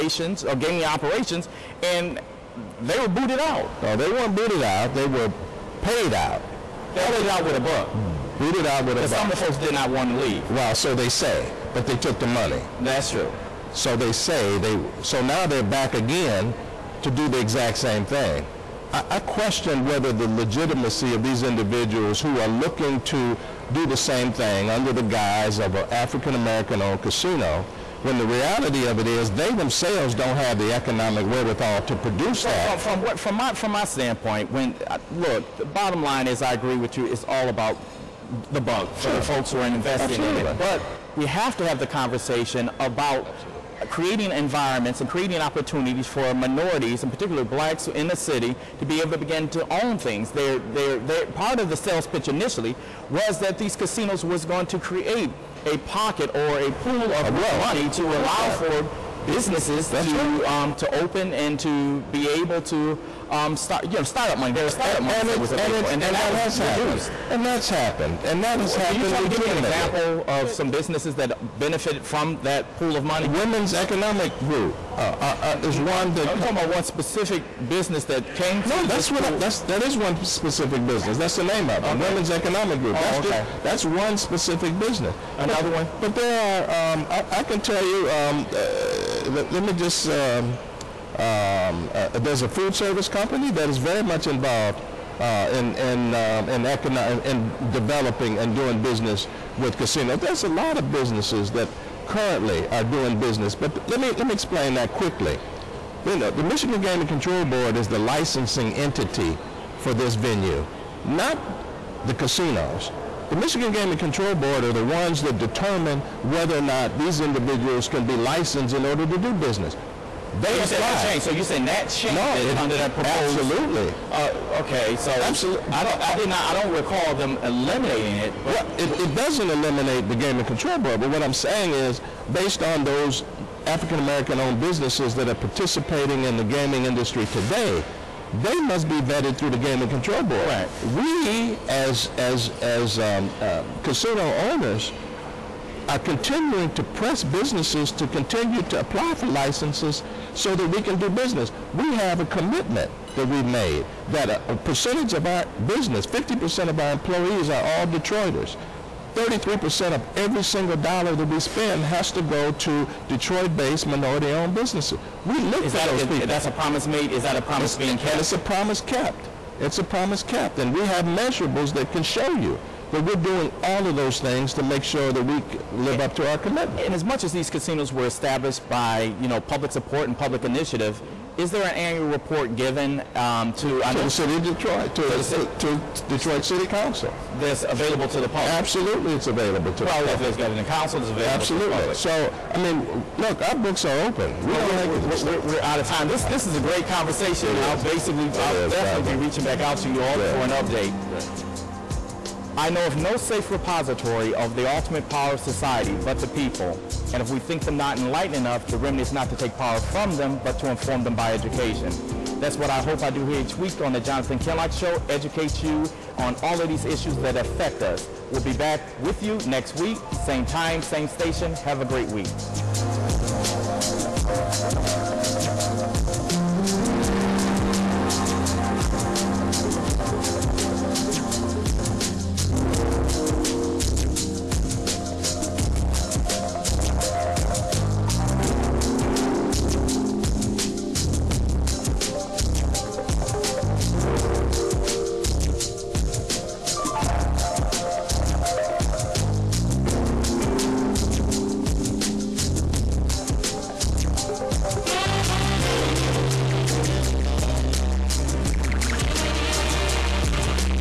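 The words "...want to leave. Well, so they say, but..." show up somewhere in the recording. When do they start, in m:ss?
0:09.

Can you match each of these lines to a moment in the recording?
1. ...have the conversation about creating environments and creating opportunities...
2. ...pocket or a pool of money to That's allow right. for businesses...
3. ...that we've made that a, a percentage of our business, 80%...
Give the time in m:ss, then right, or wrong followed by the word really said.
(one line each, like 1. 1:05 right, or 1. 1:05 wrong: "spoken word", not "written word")
1. 0:41 right
2. 0:55 right
3. 2:33 wrong: "50", not "80".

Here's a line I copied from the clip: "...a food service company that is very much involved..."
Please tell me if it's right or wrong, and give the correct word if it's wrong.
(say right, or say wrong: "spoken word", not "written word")
right.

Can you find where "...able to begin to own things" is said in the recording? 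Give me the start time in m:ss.
0:49.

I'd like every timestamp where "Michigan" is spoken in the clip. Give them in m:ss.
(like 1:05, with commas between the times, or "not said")
1:46, 1:53.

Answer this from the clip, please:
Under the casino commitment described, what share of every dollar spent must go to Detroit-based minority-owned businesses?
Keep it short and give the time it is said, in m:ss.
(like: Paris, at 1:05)
33%, at 2:39.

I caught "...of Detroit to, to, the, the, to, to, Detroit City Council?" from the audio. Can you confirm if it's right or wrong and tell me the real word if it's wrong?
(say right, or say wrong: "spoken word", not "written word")
right.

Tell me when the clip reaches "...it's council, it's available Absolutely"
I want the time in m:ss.
3:10.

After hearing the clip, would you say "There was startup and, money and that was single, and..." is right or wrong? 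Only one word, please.
wrong.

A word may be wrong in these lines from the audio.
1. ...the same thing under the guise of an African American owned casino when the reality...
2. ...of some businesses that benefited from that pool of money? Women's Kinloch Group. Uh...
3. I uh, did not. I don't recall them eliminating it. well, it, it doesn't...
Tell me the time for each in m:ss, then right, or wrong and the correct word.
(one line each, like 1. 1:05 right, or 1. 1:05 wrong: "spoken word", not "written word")
1. 0:23 right
2. 1:10 wrong: "Economic", not "Kinloch"
3. 2:06 right.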